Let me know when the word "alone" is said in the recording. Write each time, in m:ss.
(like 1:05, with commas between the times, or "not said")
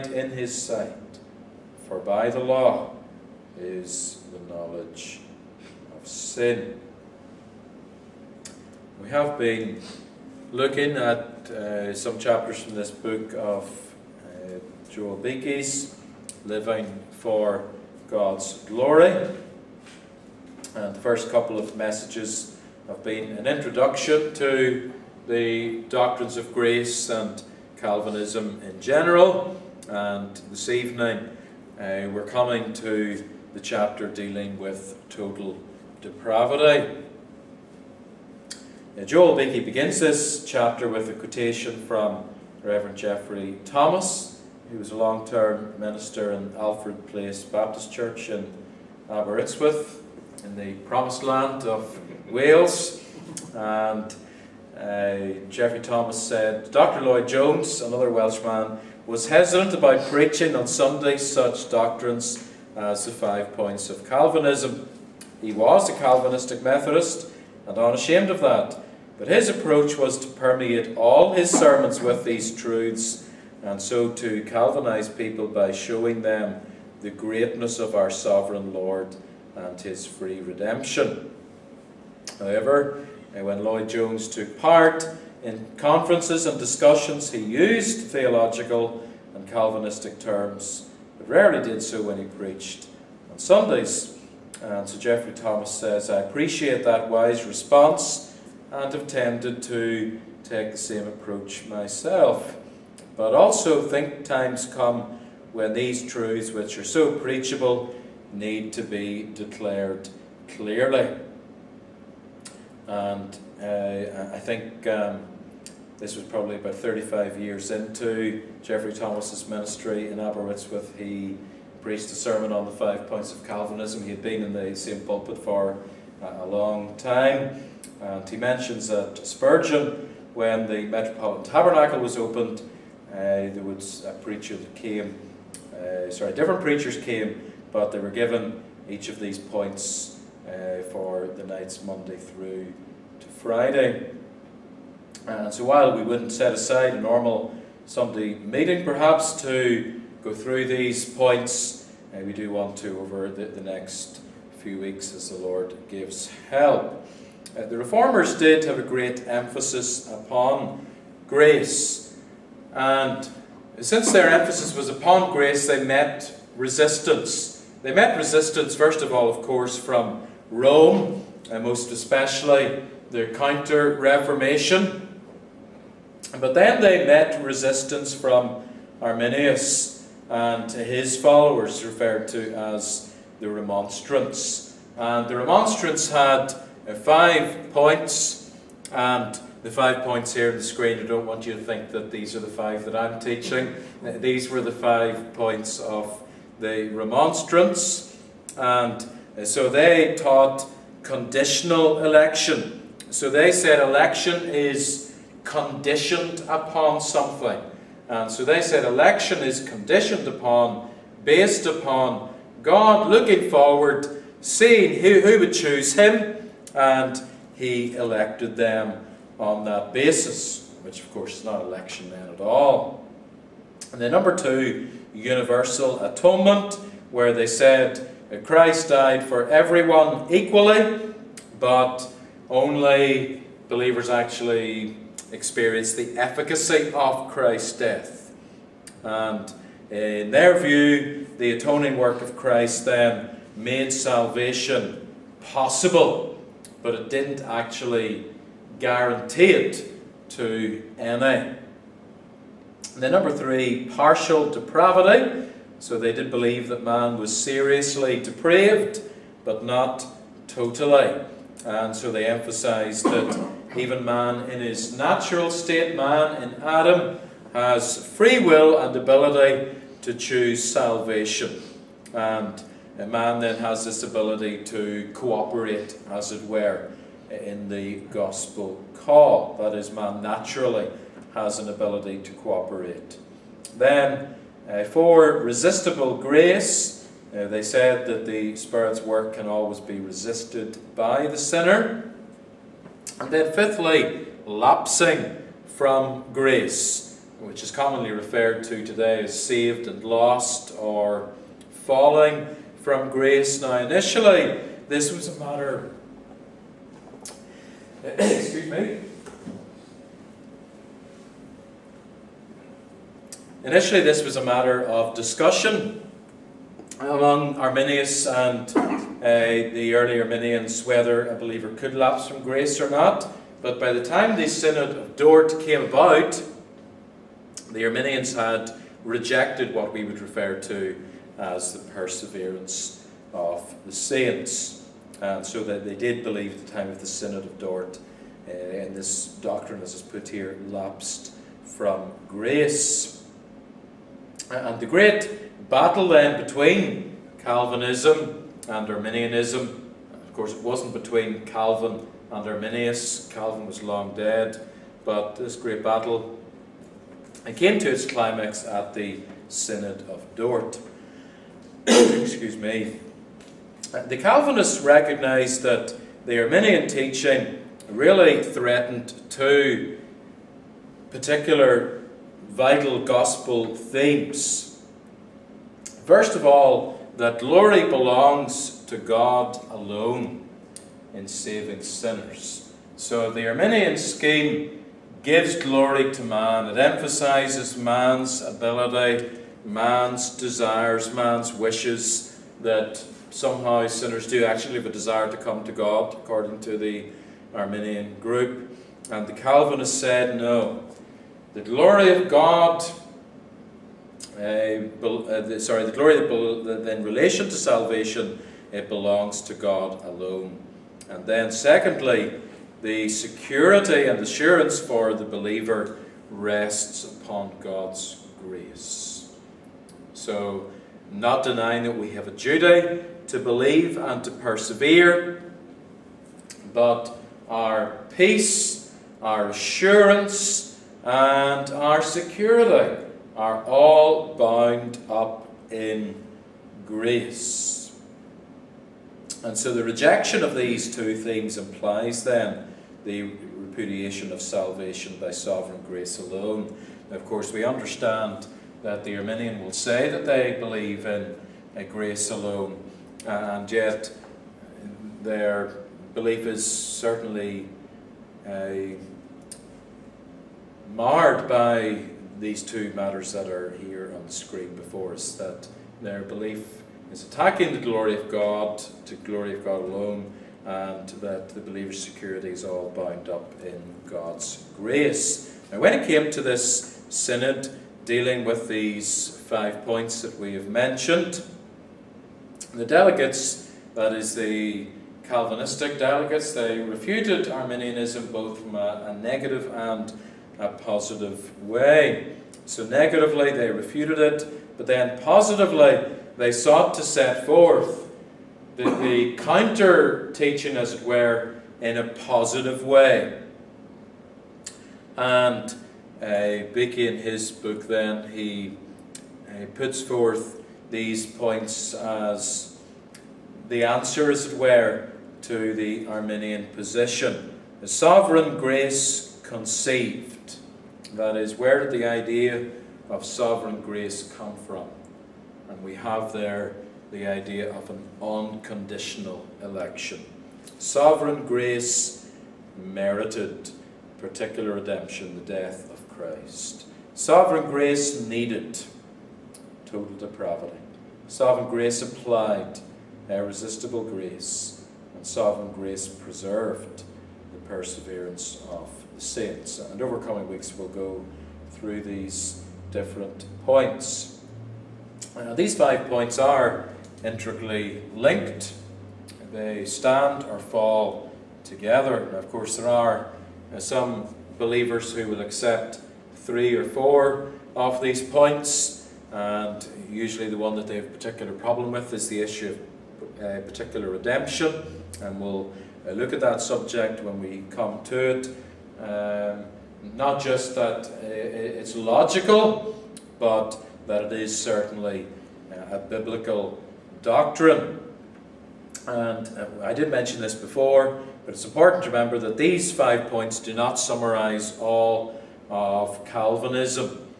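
6:19, 6:50, 7:26, 7:32, 7:49.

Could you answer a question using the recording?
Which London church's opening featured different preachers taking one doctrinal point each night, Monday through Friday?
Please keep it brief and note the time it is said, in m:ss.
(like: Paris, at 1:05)
Metropolitan Tabernacle, at 2:10.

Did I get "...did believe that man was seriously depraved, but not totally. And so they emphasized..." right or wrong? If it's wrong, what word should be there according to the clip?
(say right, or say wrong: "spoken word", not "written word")
right.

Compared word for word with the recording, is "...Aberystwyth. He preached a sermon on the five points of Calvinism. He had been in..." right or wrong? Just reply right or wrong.
right.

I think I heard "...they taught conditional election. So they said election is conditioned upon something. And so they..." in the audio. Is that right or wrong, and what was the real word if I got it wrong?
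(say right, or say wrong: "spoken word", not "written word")
right.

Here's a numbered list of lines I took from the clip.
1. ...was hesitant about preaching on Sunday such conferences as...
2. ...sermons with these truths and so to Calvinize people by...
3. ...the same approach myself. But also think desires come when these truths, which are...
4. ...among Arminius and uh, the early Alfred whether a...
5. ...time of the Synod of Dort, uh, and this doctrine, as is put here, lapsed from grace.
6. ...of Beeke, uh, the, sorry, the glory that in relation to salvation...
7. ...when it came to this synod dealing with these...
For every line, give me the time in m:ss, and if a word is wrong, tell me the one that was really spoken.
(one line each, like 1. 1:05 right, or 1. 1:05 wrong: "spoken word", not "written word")
1. 0:59 wrong: "doctrines", not "conferences"
2. 1:11 right
3. 1:40 wrong: "times", not "desires"
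4. 5:16 wrong: "Arminians", not "Alfred"
5. 5:36 right
6. 6:42 wrong: "God", not "Beeke"
7. 7:55 right.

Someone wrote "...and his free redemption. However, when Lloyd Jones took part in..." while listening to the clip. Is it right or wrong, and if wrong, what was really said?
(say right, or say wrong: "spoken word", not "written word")
right.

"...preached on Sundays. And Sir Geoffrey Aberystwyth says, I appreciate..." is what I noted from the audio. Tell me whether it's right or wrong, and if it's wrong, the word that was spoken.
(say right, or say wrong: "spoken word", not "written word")
wrong: "Thomas", not "Aberystwyth".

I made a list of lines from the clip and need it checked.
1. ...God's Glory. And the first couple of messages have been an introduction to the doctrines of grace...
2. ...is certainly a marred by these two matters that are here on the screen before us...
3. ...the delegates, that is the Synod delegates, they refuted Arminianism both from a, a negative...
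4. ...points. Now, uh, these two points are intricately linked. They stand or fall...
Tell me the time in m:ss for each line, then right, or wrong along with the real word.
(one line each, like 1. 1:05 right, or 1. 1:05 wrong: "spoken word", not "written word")
1. 0:18 right
2. 7:36 right
3. 8:02 wrong: "Calvinistic", not "Synod"
4. 9:13 wrong: "five", not "two".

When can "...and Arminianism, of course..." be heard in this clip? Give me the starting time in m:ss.
5:48.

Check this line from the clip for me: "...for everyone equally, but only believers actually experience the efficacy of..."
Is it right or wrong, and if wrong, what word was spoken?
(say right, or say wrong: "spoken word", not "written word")
right.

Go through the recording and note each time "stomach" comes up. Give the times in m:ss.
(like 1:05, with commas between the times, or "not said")
not said.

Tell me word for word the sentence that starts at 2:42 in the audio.
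And since their emphasis was upon grace, they met resistance.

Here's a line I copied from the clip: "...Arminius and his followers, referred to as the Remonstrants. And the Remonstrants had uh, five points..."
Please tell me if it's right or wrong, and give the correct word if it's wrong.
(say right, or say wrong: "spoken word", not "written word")
right.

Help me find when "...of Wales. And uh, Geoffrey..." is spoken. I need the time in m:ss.
0:51.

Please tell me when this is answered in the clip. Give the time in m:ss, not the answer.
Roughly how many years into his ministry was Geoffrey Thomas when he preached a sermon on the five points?
1:56.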